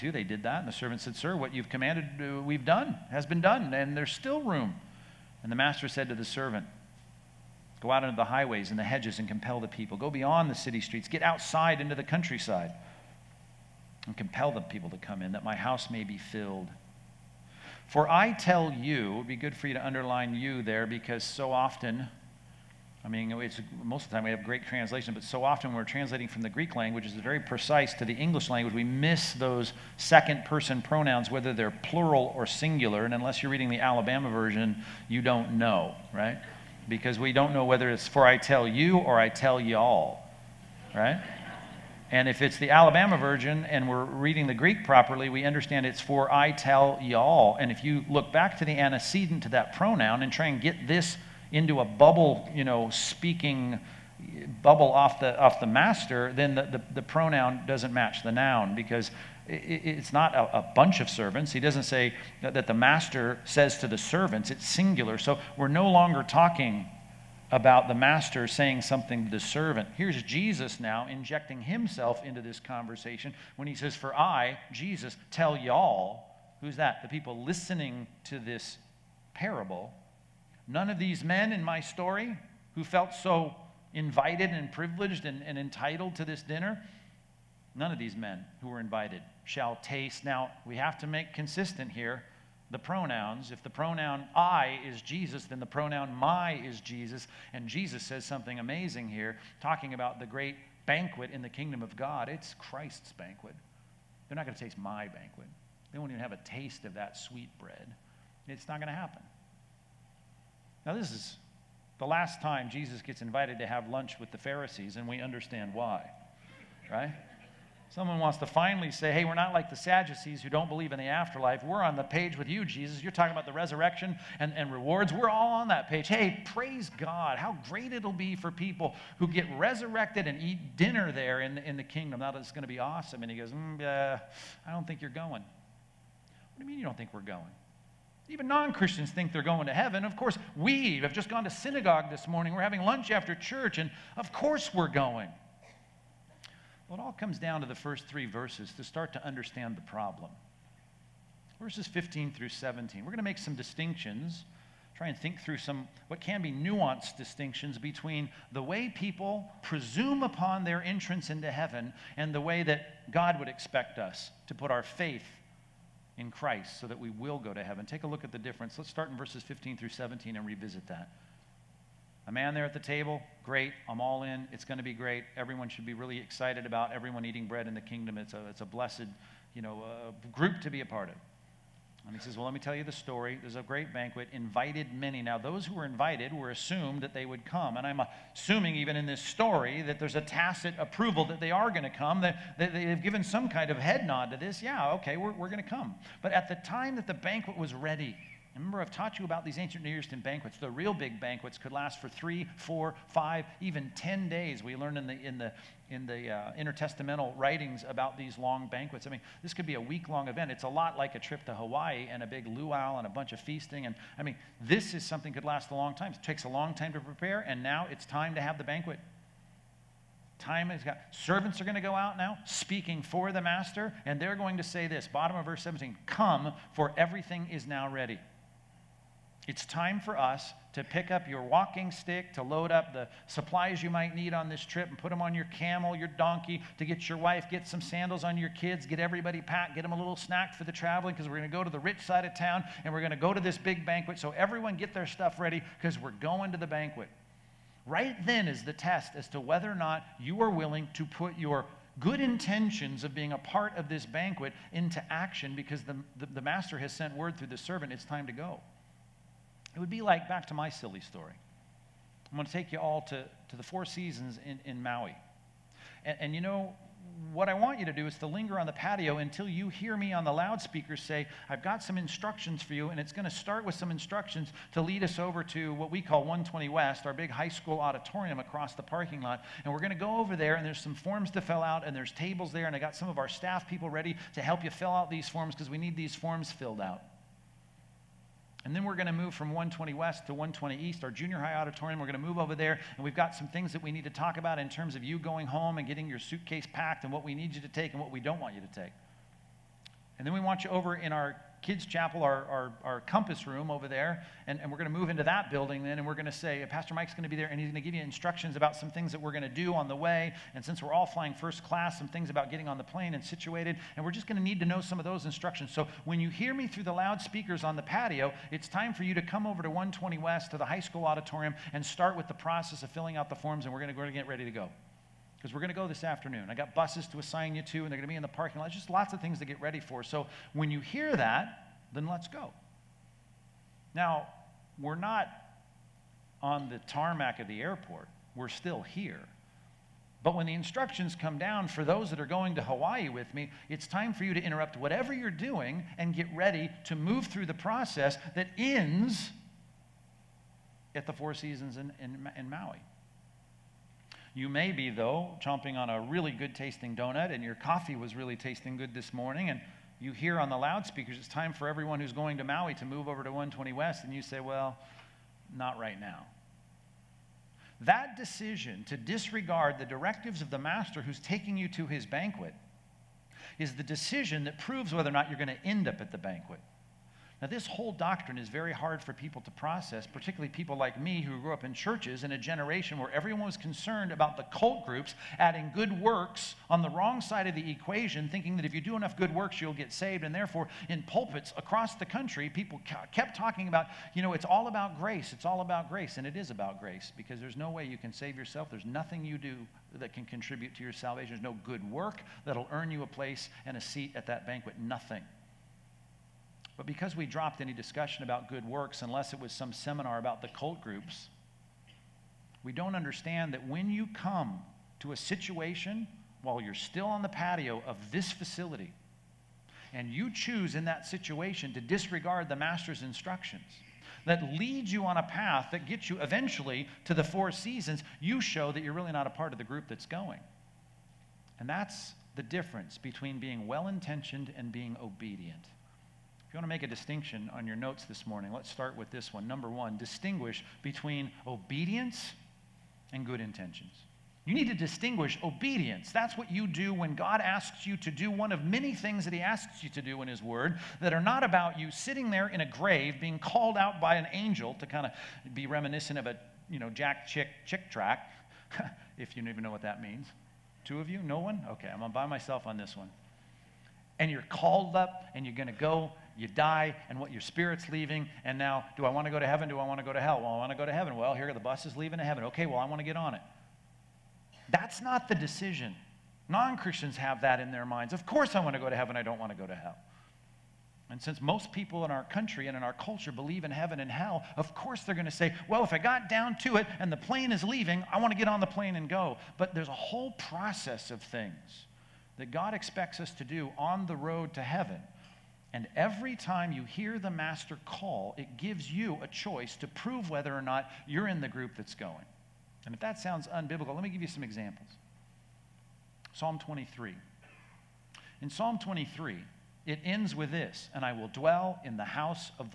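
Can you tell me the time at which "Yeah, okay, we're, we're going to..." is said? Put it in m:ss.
3:14.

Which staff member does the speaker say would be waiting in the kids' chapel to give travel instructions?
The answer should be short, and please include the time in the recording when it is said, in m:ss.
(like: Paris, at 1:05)
Pastor Mike, at 5:06.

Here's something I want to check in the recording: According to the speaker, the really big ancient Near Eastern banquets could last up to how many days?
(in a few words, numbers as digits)
10.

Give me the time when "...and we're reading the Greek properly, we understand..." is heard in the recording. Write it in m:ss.
0:43.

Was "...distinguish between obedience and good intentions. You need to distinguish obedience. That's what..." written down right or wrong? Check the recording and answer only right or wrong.
right.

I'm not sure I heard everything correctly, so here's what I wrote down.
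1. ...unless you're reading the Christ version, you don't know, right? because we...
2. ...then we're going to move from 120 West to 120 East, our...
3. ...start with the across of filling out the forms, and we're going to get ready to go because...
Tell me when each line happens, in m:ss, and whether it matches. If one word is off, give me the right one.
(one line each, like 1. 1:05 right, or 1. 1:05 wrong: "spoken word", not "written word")
1. 0:33 wrong: "Alabama", not "Christ"
2. 4:48 right
3. 5:21 wrong: "process", not "across".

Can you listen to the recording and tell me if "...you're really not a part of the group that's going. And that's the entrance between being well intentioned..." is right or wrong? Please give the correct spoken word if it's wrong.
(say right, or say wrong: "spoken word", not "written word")
wrong: "difference", not "entrance".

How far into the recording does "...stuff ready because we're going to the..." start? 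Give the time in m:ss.
4:05.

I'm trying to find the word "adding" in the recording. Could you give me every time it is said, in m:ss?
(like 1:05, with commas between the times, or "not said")
6:25.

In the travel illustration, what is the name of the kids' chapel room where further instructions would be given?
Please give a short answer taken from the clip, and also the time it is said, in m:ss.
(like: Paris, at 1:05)
compass room, at 5:03.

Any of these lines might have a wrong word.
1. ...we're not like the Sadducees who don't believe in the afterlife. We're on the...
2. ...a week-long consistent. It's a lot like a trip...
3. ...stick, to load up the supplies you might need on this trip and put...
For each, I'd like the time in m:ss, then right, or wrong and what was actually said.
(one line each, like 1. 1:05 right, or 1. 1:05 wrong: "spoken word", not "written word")
1. 1:59 right
2. 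3:29 wrong: "event", not "consistent"
3. 3:51 right.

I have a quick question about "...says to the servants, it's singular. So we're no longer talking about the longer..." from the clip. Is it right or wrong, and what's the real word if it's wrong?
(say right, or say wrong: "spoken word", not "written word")
wrong: "master", not "longer".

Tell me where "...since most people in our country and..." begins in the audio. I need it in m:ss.
8:01.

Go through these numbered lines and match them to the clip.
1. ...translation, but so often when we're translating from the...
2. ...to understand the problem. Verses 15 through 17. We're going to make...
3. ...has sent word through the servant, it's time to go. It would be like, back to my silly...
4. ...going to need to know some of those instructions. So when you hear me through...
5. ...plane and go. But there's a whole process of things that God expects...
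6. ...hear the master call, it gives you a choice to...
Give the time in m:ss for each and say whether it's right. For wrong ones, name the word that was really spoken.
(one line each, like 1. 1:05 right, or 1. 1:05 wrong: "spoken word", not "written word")
1. 0:24 right
2. 2:29 right
3. 4:16 right
4. 5:14 right
5. 8:08 right
6. 8:16 right.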